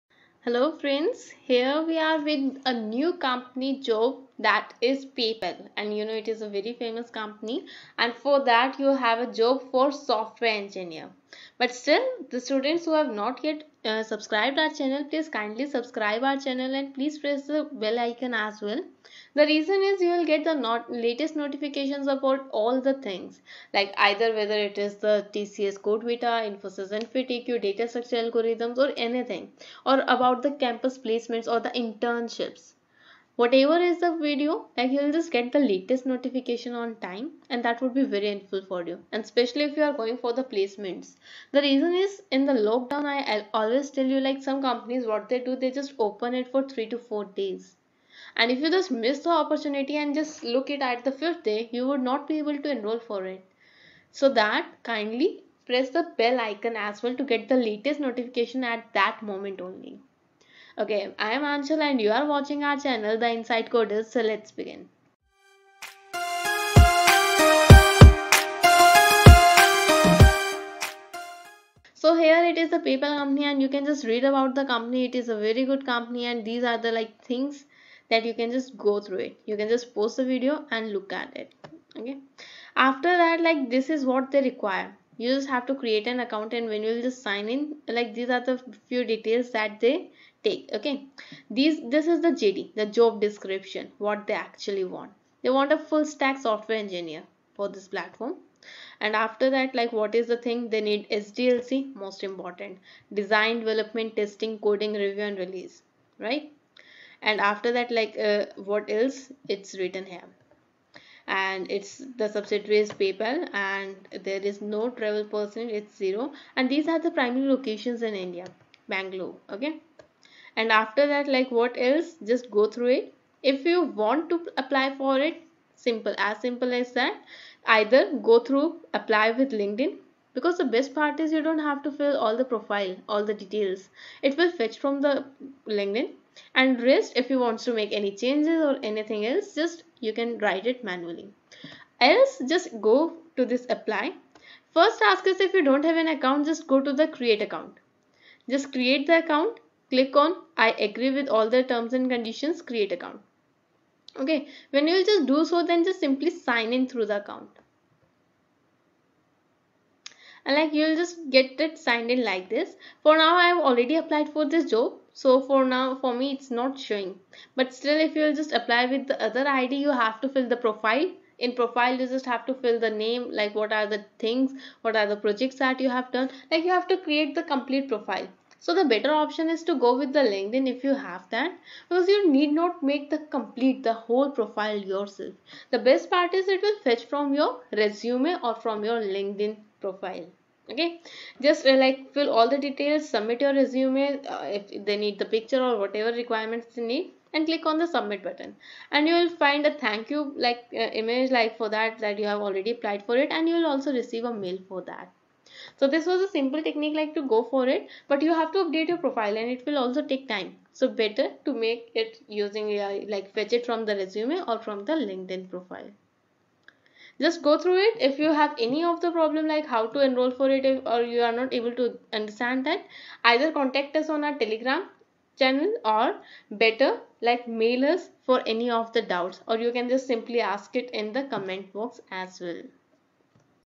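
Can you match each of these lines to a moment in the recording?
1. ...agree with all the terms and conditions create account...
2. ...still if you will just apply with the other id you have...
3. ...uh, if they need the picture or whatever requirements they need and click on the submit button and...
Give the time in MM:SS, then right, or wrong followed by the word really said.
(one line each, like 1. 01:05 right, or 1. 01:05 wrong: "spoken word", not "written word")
1. 02:30 right
2. 02:47 right
3. 03:14 right.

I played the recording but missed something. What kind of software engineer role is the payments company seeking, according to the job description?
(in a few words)
Full stack.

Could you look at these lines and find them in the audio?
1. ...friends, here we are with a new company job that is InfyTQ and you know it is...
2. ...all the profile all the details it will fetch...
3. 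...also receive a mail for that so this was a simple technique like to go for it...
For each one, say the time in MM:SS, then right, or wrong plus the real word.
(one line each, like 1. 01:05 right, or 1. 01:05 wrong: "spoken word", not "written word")
1. 00:00 wrong: "PayPal", not "InfyTQ"
2. 02:12 right
3. 03:23 right.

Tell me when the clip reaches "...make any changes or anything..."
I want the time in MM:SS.
02:17.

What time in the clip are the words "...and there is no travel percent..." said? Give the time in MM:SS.
01:53.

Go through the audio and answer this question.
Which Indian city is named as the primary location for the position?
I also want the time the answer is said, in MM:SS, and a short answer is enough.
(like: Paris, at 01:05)
Bangalore, at 01:58.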